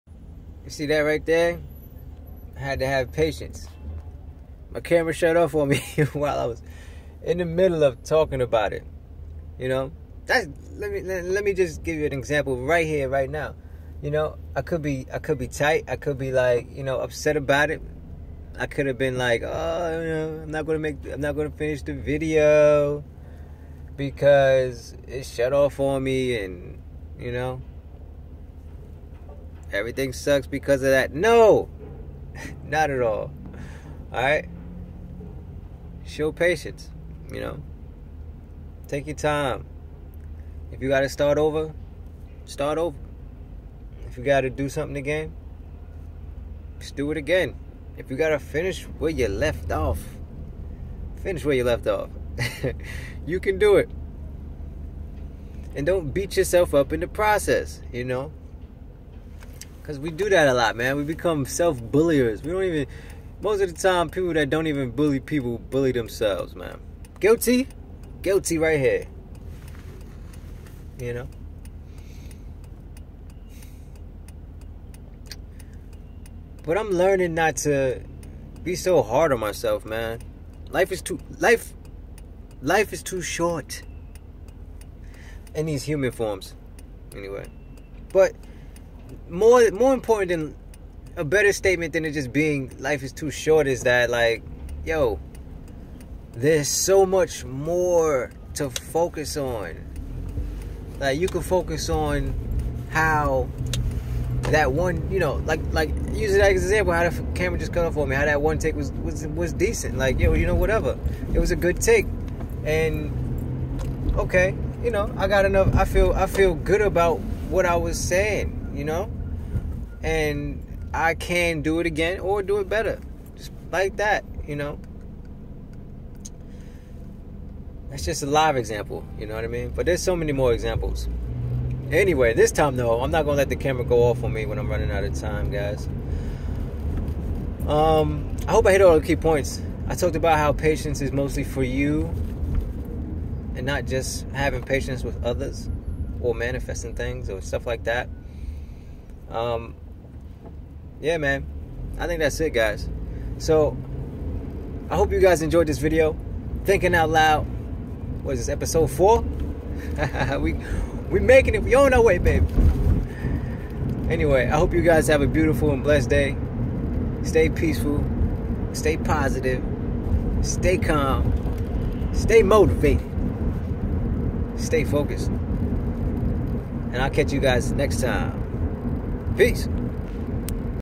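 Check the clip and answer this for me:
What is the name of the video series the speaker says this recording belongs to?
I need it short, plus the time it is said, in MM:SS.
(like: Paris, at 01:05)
Thinking Out Loud, at 02:36.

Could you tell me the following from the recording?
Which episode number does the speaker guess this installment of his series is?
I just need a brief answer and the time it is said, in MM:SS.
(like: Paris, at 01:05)
4, at 02:38.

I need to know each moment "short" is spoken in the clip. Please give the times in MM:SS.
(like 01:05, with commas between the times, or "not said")
01:23, 01:33.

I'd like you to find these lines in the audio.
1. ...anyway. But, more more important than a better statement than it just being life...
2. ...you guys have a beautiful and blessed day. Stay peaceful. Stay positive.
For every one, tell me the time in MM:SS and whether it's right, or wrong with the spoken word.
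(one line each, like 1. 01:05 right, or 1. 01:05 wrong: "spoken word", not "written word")
1. 01:27 right
2. 02:44 right.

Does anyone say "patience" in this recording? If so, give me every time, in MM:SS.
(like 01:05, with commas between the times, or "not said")
00:03, 00:36, 02:20, 02:24.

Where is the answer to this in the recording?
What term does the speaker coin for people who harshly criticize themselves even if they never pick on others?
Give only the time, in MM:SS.
01:01.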